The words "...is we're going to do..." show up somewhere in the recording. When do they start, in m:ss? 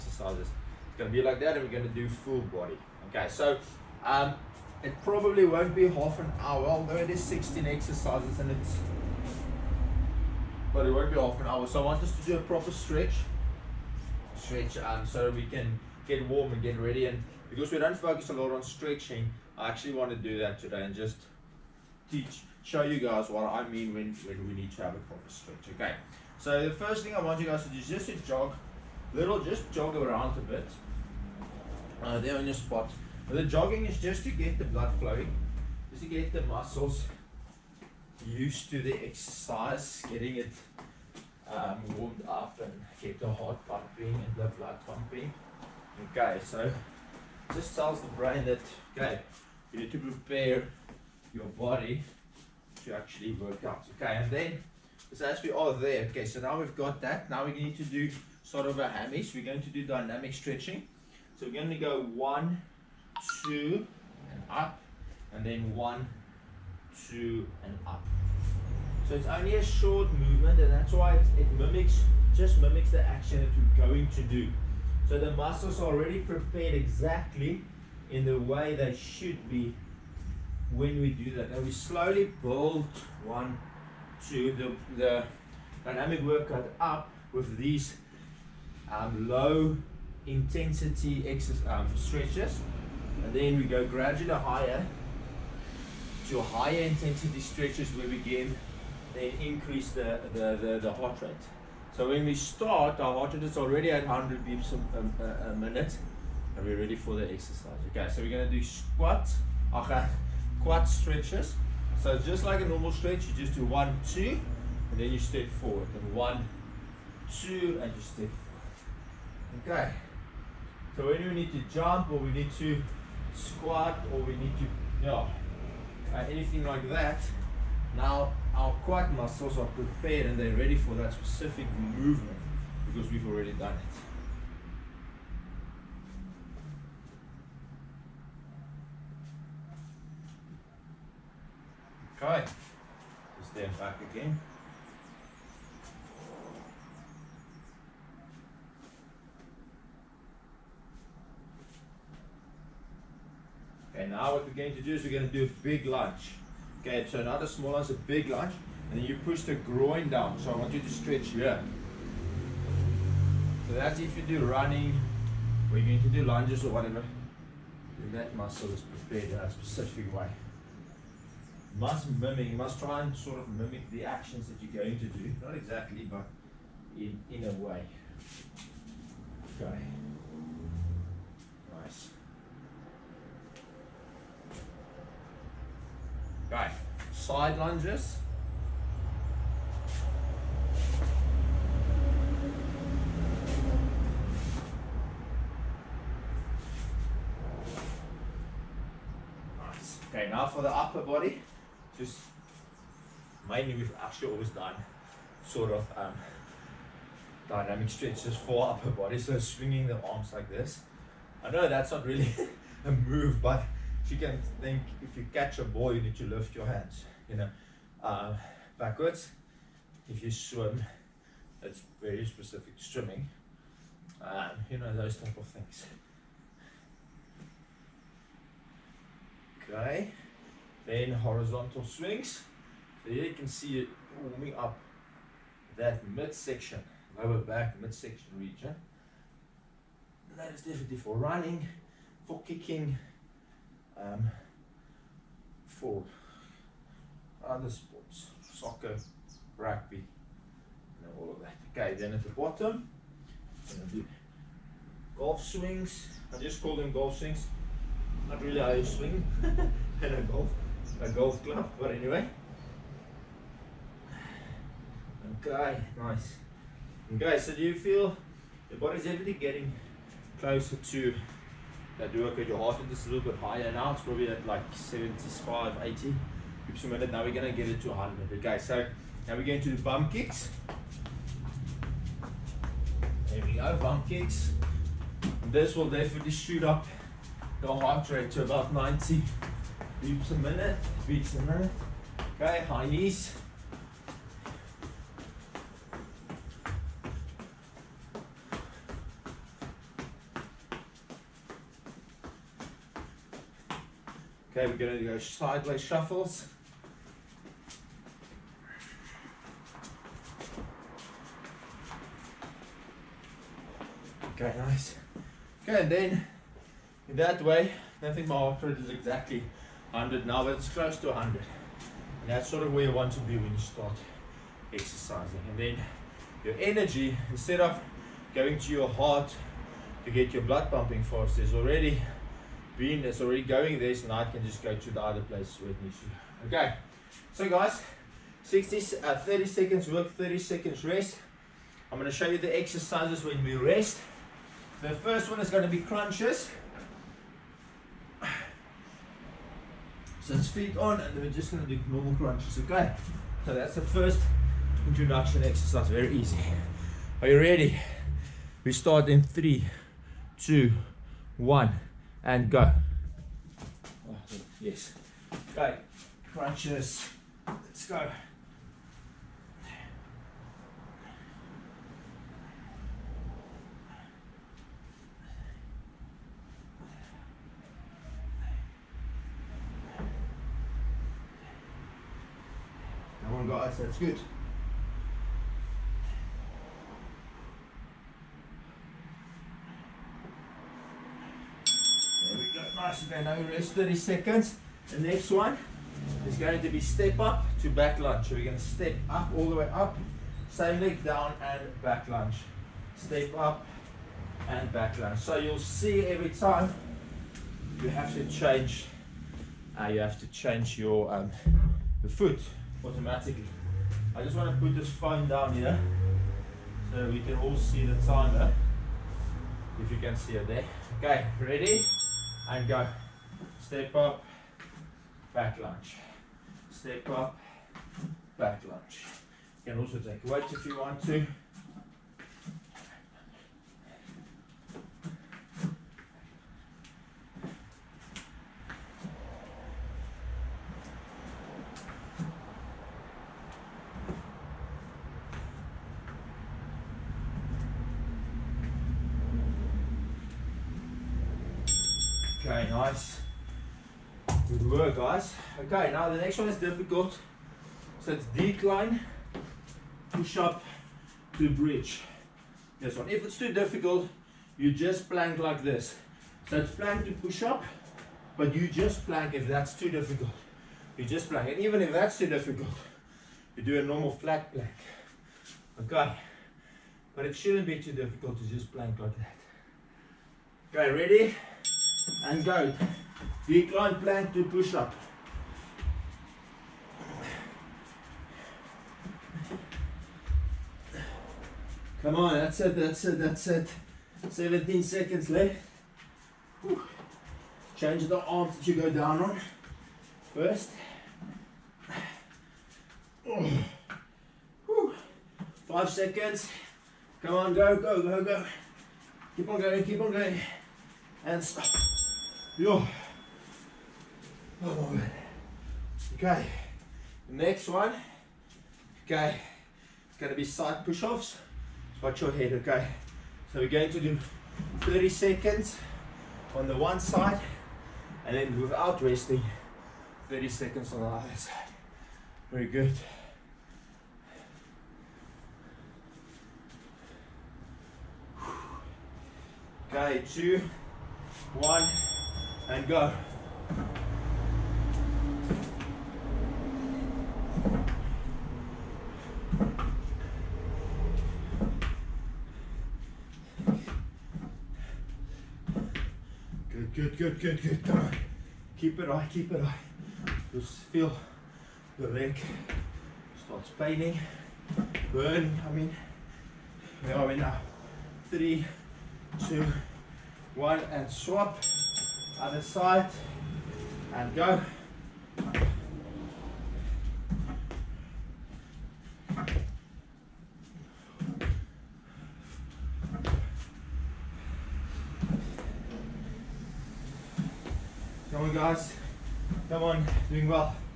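2:34.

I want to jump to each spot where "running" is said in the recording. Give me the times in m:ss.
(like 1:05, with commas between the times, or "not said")
2:44, 4:01.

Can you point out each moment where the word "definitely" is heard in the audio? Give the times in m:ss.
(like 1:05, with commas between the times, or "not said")
4:00, 4:45.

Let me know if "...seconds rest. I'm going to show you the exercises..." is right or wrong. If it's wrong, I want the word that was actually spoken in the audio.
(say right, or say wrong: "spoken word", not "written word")
right.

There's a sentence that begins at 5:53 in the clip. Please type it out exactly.
So that's the first introduction exercise, very easy.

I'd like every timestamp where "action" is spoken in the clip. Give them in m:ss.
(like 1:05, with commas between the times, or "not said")
1:13, 2:54.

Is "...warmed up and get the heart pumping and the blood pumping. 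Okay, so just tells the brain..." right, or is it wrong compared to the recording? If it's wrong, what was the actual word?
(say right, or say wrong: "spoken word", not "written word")
right.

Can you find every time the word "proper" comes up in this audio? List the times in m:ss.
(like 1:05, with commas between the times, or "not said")
0:12, 0:24.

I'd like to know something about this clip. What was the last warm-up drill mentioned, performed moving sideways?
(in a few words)
sideways shuffles.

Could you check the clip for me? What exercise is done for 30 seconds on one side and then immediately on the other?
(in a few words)
side push-offs.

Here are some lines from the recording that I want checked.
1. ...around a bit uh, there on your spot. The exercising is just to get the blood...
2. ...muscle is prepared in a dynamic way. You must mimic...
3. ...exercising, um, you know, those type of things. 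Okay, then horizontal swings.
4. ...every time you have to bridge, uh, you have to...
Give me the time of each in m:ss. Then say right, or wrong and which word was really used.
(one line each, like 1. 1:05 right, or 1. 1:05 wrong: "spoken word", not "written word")
1. 0:29 wrong: "jogging", not "exercising"
2. 2:48 wrong: "specific", not "dynamic"
3. 3:42 wrong: "swimming", not "exercising"
4. 6:46 wrong: "change", not "bridge".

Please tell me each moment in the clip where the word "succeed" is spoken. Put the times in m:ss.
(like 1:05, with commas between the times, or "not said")
not said.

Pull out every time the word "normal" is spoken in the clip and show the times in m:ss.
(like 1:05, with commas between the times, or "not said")
1:52, 5:51, 7:53.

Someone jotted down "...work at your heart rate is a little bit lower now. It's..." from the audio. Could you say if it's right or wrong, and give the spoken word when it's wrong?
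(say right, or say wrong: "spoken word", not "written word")
wrong: "higher", not "lower".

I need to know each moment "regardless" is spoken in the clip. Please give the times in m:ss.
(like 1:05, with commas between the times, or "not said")
not said.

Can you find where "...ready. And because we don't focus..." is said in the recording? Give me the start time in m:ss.
0:16.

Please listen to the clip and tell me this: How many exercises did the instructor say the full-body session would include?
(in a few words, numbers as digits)
16.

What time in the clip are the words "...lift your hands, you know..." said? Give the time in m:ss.
3:36.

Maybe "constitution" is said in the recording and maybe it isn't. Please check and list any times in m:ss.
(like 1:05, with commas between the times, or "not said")
not said.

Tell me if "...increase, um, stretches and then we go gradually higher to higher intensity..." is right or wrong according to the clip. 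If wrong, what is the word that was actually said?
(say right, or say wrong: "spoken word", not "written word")
wrong: "exercise", not "increase".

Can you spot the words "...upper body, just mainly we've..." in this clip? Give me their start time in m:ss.
3:20.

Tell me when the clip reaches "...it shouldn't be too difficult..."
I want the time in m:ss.
7:57.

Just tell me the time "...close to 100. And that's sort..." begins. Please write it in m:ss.
5:20.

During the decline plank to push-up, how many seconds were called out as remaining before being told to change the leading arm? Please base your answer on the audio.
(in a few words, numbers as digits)
17.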